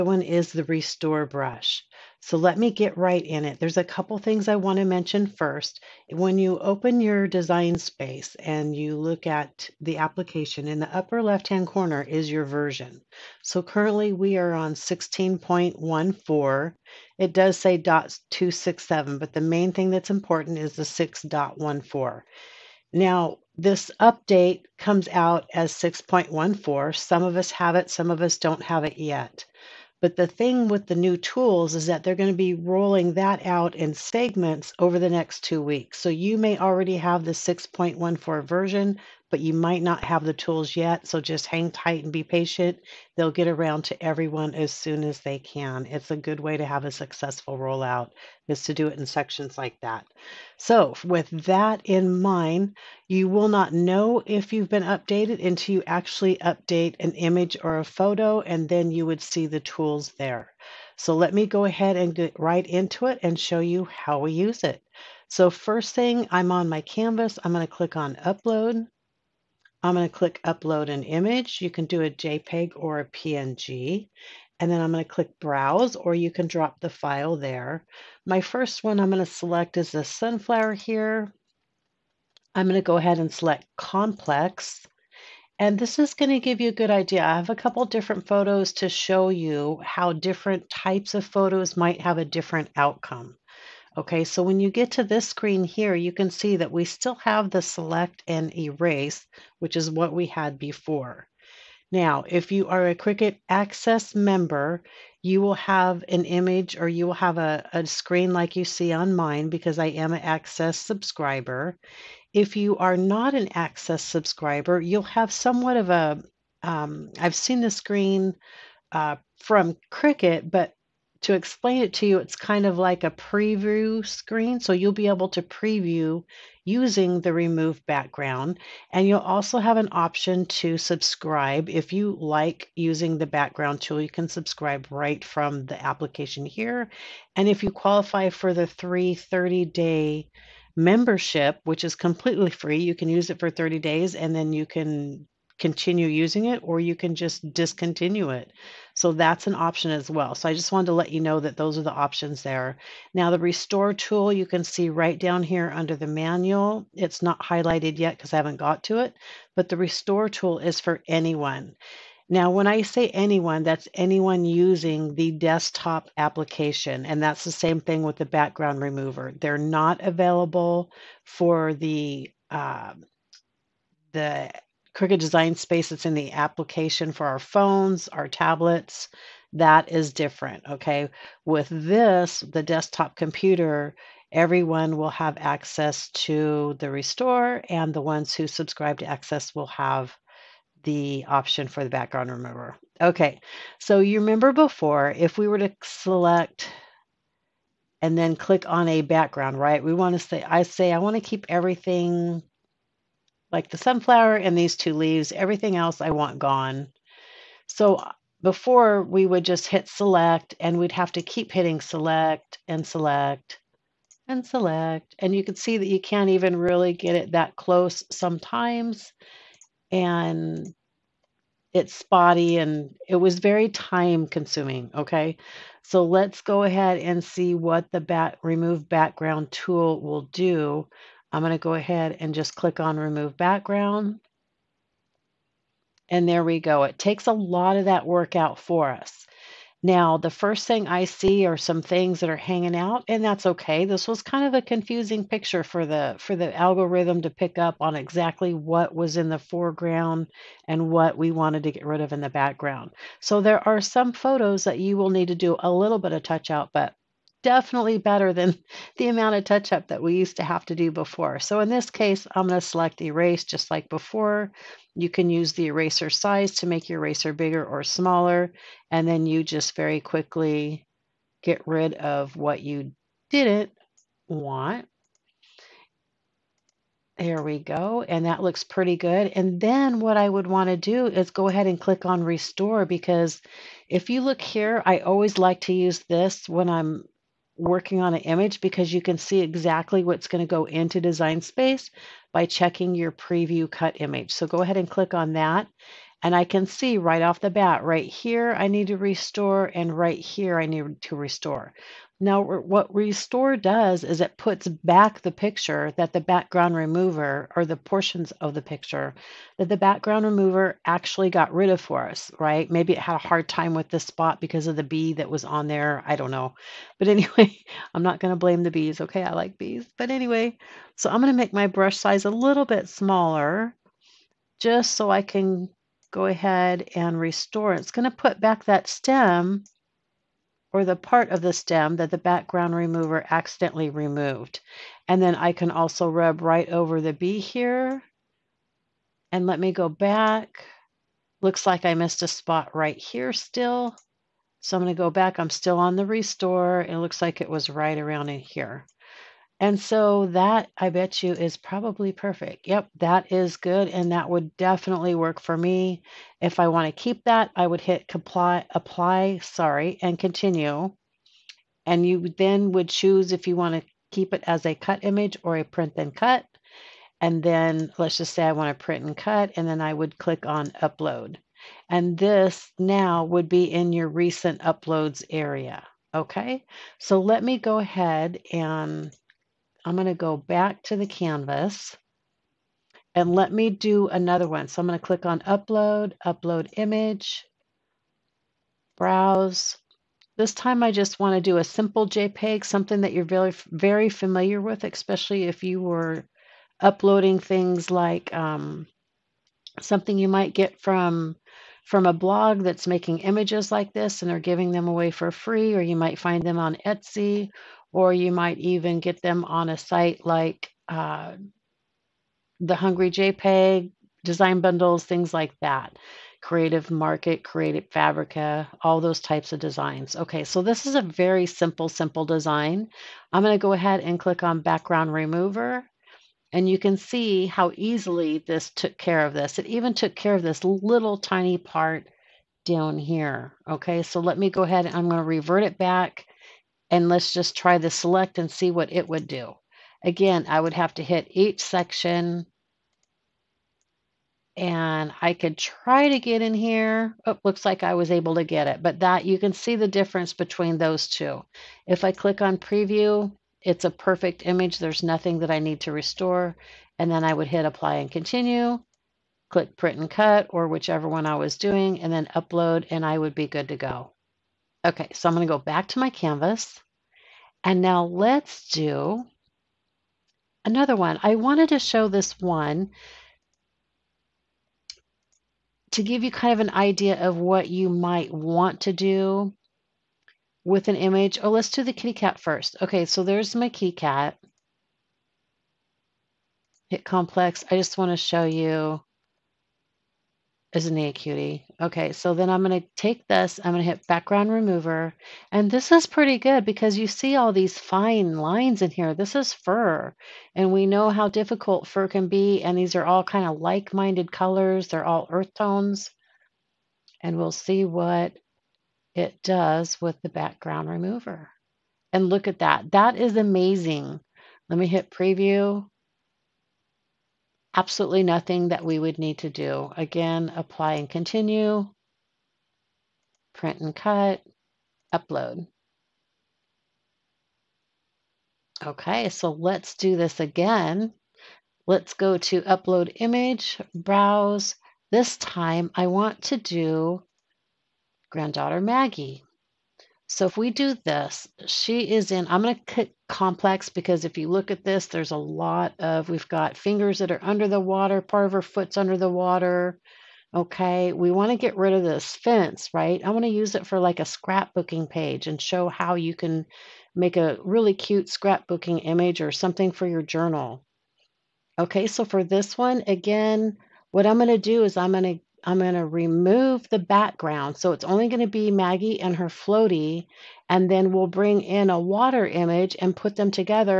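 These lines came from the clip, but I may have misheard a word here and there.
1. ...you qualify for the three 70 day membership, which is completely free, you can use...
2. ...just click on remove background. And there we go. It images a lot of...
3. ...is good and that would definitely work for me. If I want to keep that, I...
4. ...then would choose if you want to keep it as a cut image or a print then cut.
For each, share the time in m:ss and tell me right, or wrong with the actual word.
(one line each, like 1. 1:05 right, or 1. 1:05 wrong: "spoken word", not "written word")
1. 2:17 wrong: "30", not "70"
2. 3:52 wrong: "takes", not "images"
3. 5:53 right
4. 6:02 right.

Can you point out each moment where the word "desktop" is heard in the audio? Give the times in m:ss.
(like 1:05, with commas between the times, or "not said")
2:45, 3:02.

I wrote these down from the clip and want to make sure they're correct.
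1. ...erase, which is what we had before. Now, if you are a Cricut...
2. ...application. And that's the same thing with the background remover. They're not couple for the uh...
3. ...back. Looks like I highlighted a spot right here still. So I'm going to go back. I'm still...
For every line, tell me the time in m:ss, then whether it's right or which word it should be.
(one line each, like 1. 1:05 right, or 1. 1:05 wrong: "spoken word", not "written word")
1. 1:38 right
2. 2:46 wrong: "available", not "couple"
3. 5:39 wrong: "missed", not "highlighted".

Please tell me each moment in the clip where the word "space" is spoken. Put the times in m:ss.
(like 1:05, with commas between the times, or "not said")
0:07, 2:55, 4:51.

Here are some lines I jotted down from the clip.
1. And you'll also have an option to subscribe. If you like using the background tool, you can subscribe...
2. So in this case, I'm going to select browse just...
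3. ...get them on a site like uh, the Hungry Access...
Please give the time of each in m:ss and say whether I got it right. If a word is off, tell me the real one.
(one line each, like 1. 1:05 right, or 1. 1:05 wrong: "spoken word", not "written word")
1. 2:08 right
2. 4:21 wrong: "erase", not "browse"
3. 6:48 wrong: "JPEG", not "Access".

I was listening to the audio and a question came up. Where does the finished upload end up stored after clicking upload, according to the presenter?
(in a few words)
recent uploads.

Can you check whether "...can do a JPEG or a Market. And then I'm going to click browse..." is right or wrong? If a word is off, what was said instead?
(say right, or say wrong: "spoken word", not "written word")
wrong: "PNG", not "Market".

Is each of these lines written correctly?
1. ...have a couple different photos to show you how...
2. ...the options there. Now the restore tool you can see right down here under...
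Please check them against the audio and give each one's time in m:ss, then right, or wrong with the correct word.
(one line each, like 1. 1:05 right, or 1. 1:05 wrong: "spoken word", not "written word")
1. 1:27 right
2. 2:31 right.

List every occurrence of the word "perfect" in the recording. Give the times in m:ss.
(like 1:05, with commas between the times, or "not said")
5:52, 7:33.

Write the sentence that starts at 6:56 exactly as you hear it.
Creative Market, Creative Fabrica, all those types of designs.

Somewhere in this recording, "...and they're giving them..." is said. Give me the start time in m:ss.
6:44.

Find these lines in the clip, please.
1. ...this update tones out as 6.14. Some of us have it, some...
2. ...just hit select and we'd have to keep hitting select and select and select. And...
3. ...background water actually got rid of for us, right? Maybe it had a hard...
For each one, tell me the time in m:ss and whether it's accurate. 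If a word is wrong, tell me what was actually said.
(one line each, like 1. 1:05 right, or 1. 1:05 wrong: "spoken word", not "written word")
1. 0:23 wrong: "comes", not "tones"
2. 3:29 right
3. 5:09 wrong: "remover", not "water".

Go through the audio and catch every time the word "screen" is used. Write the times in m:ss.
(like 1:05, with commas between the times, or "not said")
1:35, 1:47, 1:57, 2:04.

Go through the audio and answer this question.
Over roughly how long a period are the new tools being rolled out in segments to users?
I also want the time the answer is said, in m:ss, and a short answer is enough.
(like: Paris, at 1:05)
two weeks, at 0:35.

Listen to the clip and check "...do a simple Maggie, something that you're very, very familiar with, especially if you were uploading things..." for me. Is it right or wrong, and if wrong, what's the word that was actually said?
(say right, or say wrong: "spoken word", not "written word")
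wrong: "JPEG", not "Maggie".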